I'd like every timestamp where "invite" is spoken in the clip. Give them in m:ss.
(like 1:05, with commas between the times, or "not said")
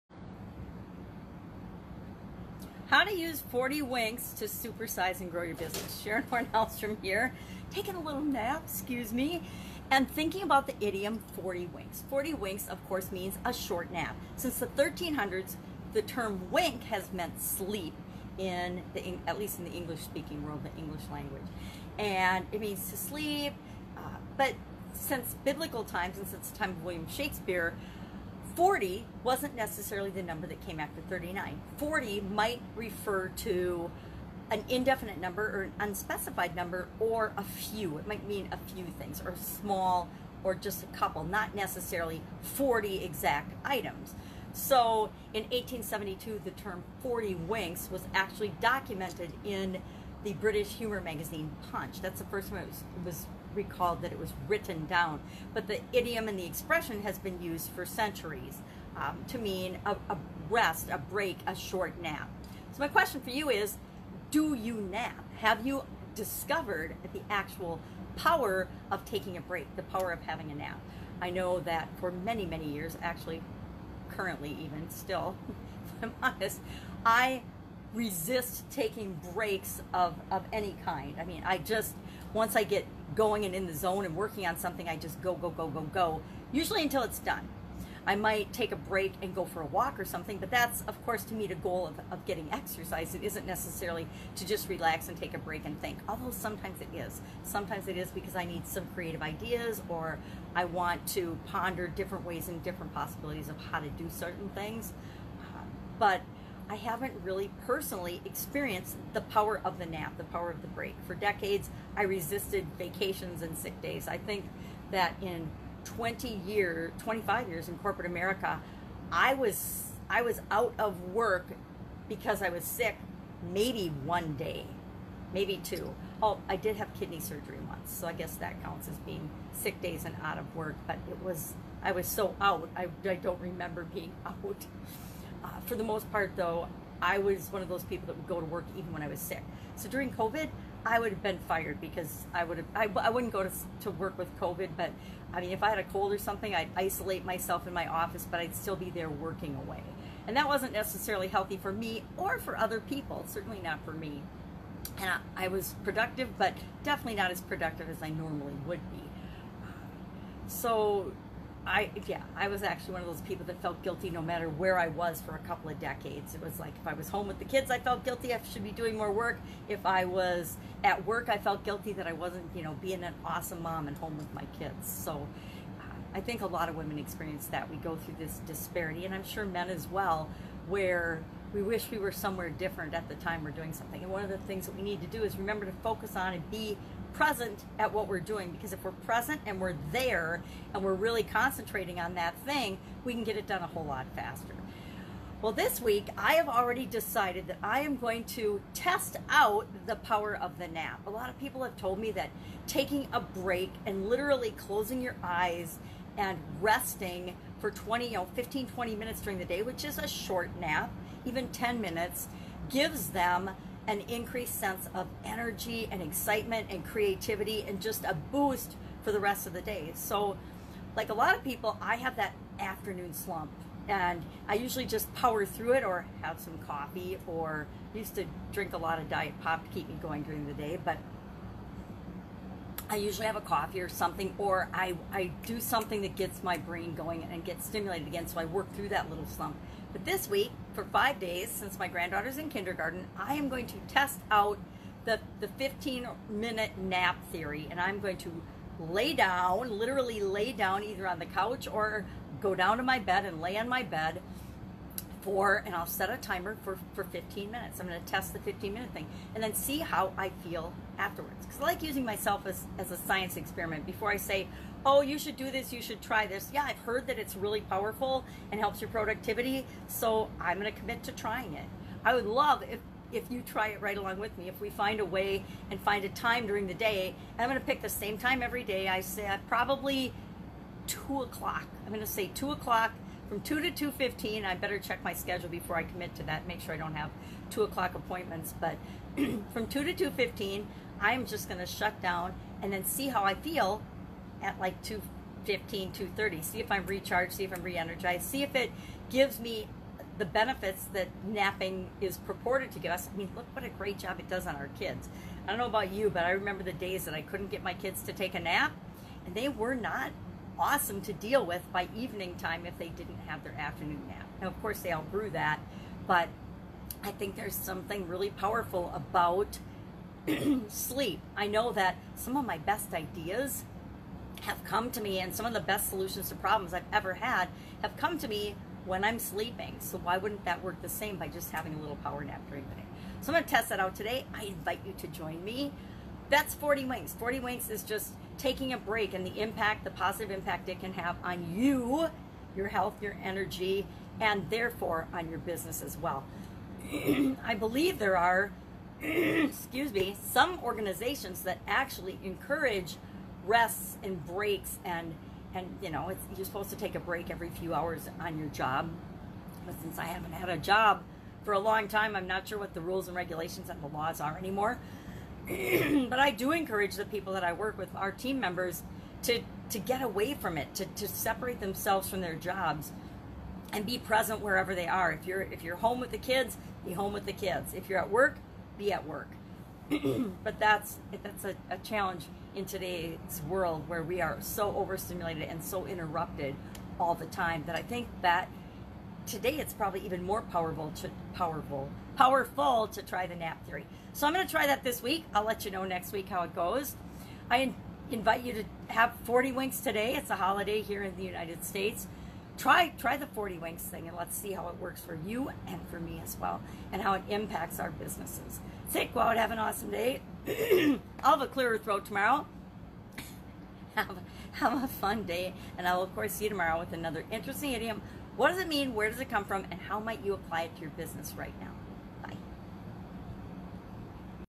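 5:34, 6:38.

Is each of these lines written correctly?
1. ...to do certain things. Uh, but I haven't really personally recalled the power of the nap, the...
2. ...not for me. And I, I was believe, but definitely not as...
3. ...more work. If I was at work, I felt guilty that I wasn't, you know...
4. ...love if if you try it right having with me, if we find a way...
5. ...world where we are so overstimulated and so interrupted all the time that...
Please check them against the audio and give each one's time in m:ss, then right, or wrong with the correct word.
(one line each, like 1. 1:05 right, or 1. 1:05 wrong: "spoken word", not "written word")
1. 1:43 wrong: "experienced", not "recalled"
2. 2:33 wrong: "productive", not "believe"
3. 2:48 right
4. 4:32 wrong: "along", not "having"
5. 6:23 right.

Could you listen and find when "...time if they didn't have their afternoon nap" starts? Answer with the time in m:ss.
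5:12.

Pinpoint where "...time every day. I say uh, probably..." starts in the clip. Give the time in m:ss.
4:38.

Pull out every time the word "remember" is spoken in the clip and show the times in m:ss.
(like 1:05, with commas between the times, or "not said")
2:13, 3:05, 5:06.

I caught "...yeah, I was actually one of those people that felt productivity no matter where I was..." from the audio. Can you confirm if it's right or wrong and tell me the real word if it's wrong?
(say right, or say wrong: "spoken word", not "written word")
wrong: "guilty", not "productivity".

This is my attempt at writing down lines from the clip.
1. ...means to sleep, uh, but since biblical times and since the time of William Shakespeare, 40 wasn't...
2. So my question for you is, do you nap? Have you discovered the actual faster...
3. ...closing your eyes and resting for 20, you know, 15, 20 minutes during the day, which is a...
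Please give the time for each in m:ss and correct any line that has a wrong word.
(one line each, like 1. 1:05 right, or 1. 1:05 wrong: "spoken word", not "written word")
1. 0:22 right
2. 1:02 wrong: "power", not "faster"
3. 3:24 right.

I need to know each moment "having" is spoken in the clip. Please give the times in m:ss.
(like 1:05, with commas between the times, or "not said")
1:10, 5:31.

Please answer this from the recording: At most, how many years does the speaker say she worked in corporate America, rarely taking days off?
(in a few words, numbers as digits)
25.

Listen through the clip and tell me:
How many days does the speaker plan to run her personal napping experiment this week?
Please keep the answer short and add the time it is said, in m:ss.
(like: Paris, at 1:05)
5, at 4:00.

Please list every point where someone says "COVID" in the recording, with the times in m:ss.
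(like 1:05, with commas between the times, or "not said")
2:20, 2:24.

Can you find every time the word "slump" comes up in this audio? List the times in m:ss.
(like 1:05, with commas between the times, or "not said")
3:43, 3:59.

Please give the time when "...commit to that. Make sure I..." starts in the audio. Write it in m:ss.
4:45.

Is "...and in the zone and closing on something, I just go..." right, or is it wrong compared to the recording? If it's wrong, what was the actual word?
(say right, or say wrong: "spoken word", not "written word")
wrong: "working", not "closing".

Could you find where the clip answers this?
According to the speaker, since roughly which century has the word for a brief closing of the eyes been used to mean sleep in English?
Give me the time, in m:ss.
0:14.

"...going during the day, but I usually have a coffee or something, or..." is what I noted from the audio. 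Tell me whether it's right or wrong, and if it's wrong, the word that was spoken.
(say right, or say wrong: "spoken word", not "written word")
right.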